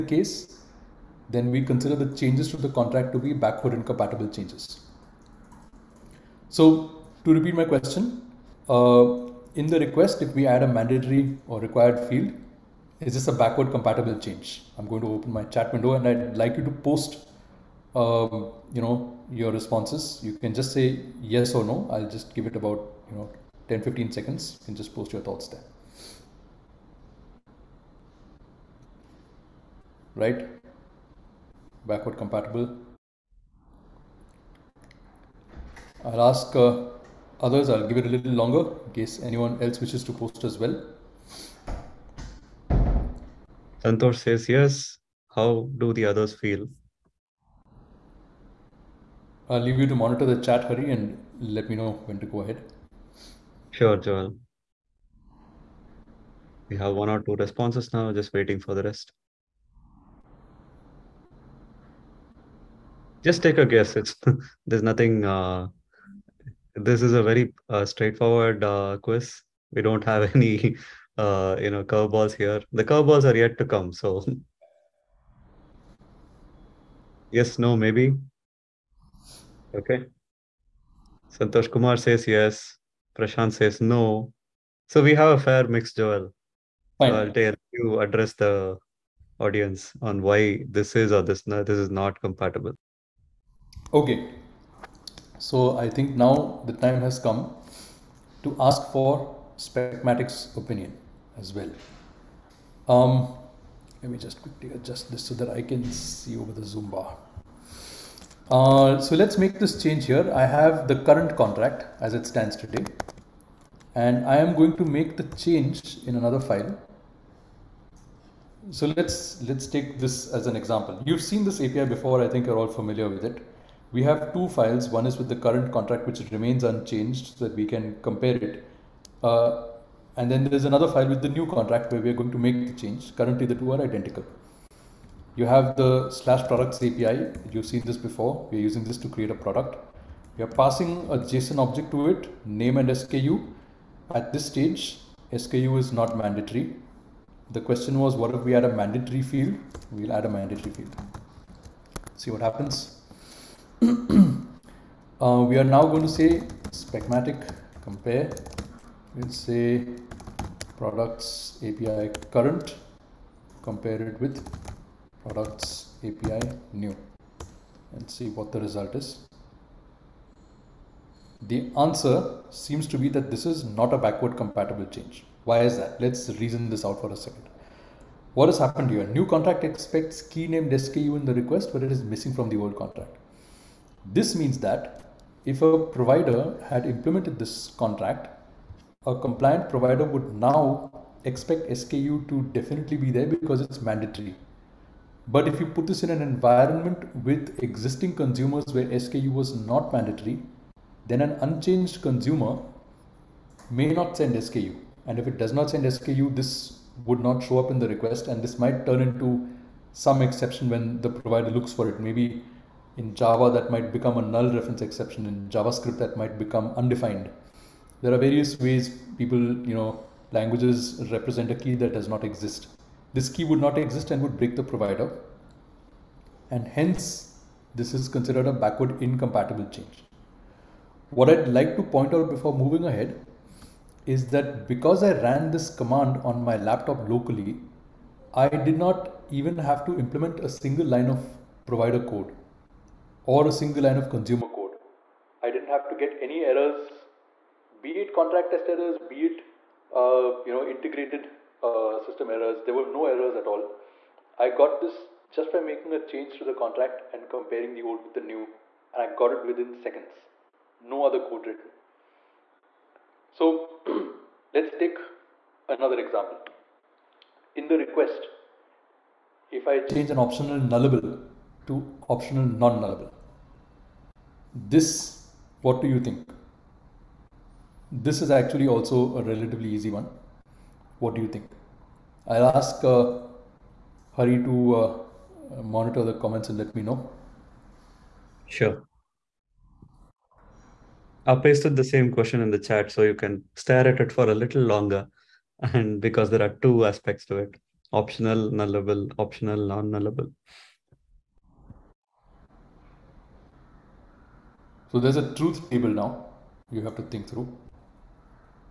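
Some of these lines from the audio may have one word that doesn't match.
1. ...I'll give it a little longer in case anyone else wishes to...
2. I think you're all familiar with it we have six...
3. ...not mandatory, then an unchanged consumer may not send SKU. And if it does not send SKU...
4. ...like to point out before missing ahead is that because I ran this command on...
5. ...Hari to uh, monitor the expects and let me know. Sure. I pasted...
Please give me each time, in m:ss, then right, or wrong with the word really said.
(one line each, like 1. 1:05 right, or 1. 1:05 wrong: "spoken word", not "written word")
1. 0:37 right
2. 2:02 wrong: "two", not "six"
3. 3:19 right
4. 3:51 wrong: "moving", not "missing"
5. 4:44 wrong: "comments", not "expects".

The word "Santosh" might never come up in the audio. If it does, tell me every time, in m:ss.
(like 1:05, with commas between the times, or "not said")
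0:43, 1:21.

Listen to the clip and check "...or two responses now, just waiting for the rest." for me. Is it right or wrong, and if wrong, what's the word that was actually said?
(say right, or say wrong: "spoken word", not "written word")
right.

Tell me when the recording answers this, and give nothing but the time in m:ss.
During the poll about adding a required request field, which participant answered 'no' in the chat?
1:23.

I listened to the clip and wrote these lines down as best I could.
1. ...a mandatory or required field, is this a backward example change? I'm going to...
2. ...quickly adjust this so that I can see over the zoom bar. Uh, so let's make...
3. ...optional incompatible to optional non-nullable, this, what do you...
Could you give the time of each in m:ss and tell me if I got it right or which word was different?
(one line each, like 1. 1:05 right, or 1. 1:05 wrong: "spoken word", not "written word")
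1. 0:10 wrong: "compatible", not "example"
2. 1:44 right
3. 4:30 wrong: "nullable", not "incompatible".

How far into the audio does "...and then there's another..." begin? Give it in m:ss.
2:10.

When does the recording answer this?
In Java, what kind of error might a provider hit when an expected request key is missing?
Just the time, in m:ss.
3:34.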